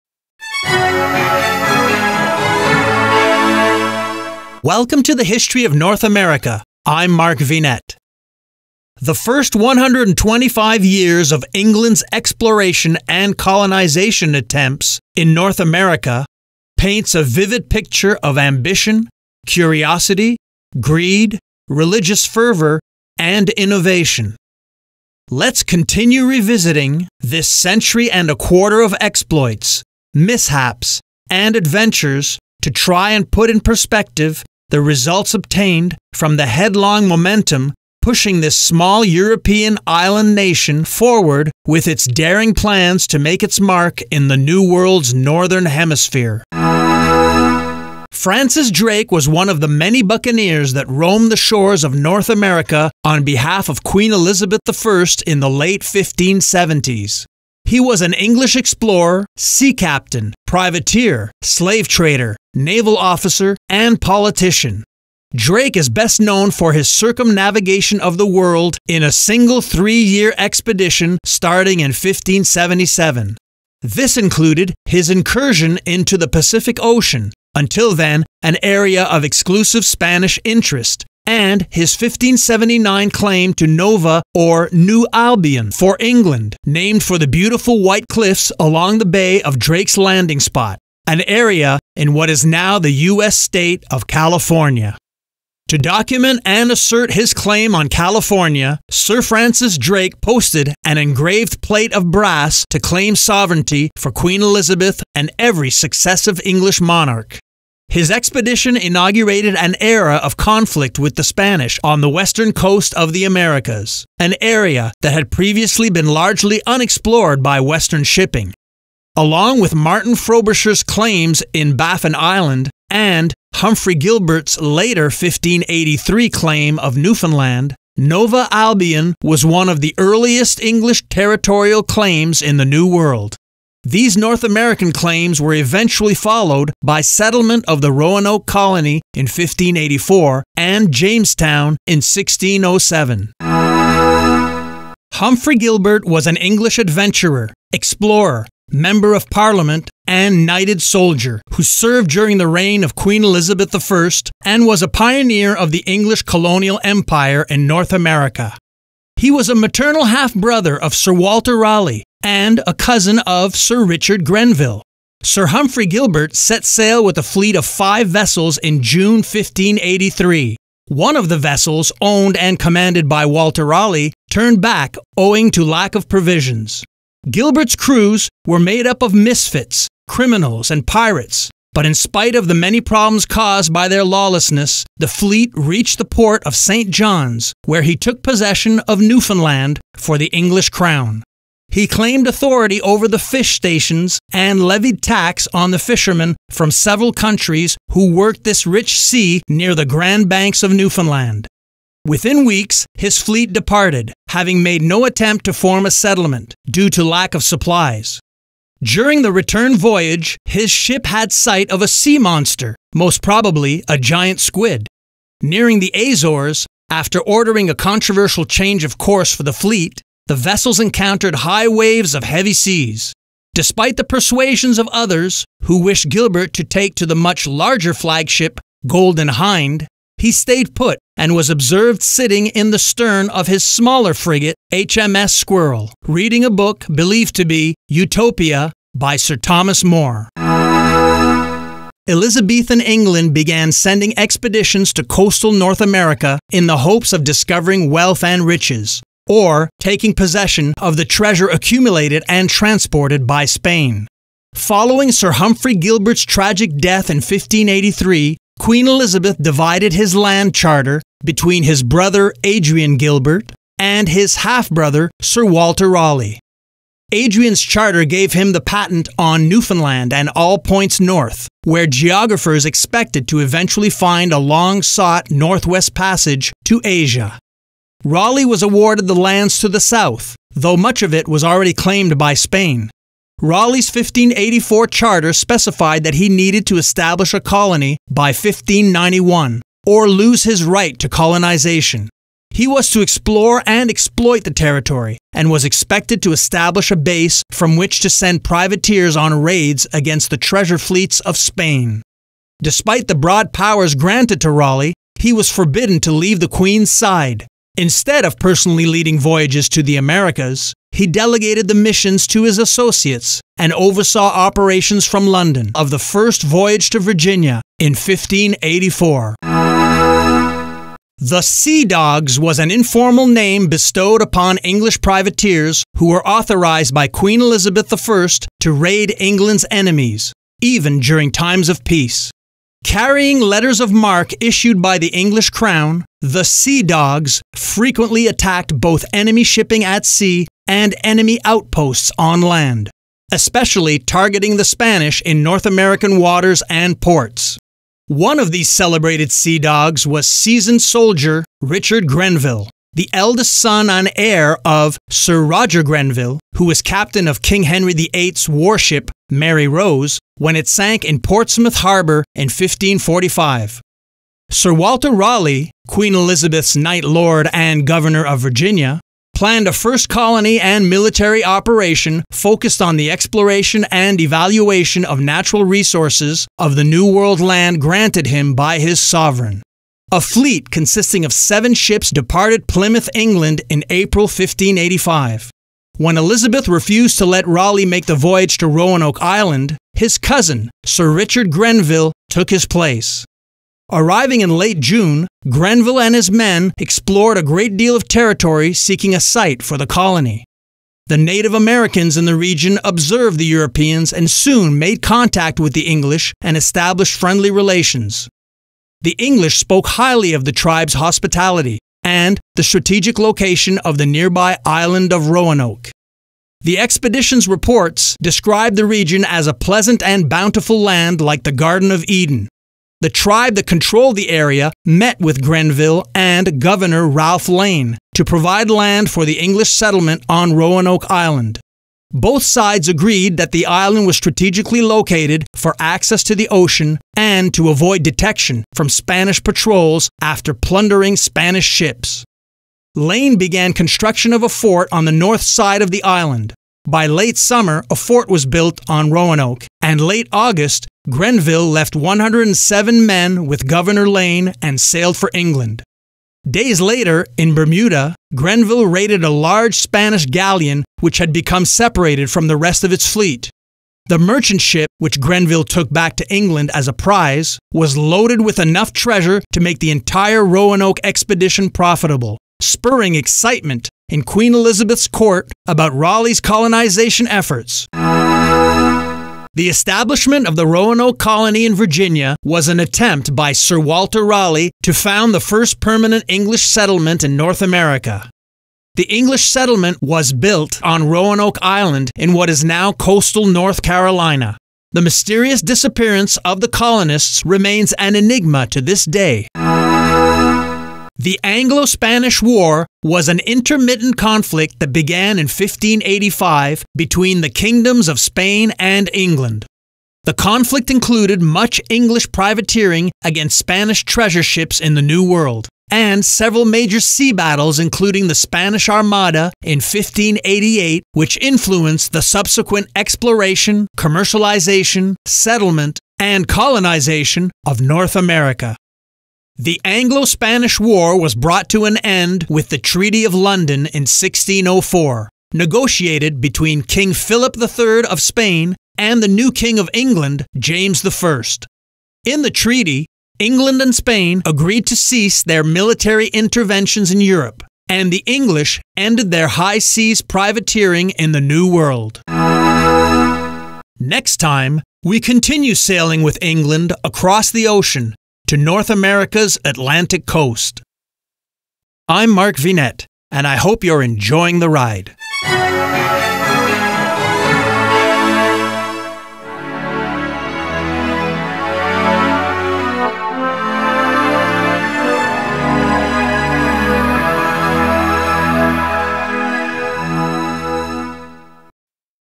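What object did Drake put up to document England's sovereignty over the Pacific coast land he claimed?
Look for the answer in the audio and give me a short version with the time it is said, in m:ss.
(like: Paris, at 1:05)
Engraved plate of brass, at 1:40.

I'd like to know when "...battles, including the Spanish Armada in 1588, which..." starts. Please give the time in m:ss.
8:37.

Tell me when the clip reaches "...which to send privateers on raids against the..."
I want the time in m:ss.
4:57.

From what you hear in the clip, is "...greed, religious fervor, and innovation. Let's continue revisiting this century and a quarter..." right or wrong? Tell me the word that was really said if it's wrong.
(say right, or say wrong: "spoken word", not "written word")
right.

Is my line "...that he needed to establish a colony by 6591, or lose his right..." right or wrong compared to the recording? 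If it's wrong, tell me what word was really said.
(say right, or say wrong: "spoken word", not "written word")
wrong: "1591", not "6591".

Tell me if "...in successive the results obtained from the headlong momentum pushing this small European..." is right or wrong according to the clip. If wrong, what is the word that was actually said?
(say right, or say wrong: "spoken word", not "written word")
wrong: "perspective", not "successive".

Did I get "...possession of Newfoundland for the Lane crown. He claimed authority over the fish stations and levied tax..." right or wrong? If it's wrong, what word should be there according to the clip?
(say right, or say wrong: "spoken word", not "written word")
wrong: "English", not "Lane".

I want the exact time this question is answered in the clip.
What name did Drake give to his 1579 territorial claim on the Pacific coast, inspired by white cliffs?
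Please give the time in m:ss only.
1:24.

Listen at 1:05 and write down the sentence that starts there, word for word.
Drake is best known for his circumnavigation of the world in a single three year expedition starting in 1577.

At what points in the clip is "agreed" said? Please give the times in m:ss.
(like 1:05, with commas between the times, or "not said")
7:12, 9:04.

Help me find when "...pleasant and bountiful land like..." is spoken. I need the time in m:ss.
6:59.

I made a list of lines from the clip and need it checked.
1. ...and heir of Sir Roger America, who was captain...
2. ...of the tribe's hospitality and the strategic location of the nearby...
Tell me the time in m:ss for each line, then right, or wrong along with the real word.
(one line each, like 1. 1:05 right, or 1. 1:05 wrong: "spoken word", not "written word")
1. 5:53 wrong: "Grenville", not "America"
2. 6:50 right.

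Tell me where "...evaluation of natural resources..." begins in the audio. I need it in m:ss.
6:14.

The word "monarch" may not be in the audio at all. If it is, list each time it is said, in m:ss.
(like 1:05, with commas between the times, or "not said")
1:46.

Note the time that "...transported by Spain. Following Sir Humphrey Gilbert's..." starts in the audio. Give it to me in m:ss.
4:12.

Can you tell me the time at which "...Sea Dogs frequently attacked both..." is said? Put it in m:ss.
5:36.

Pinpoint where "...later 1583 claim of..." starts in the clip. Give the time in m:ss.
2:04.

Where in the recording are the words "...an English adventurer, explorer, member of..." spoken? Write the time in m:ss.
2:26.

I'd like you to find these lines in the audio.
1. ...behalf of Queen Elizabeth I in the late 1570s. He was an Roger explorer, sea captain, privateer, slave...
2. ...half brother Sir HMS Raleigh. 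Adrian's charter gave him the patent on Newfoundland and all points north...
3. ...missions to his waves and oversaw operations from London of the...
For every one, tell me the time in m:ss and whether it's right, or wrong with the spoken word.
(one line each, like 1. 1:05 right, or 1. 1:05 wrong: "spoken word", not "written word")
1. 0:53 wrong: "English", not "Roger"
2. 4:24 wrong: "Walter", not "HMS"
3. 5:11 wrong: "associates", not "waves".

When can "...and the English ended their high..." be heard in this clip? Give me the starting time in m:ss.
9:07.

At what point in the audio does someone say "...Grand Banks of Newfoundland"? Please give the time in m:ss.
3:19.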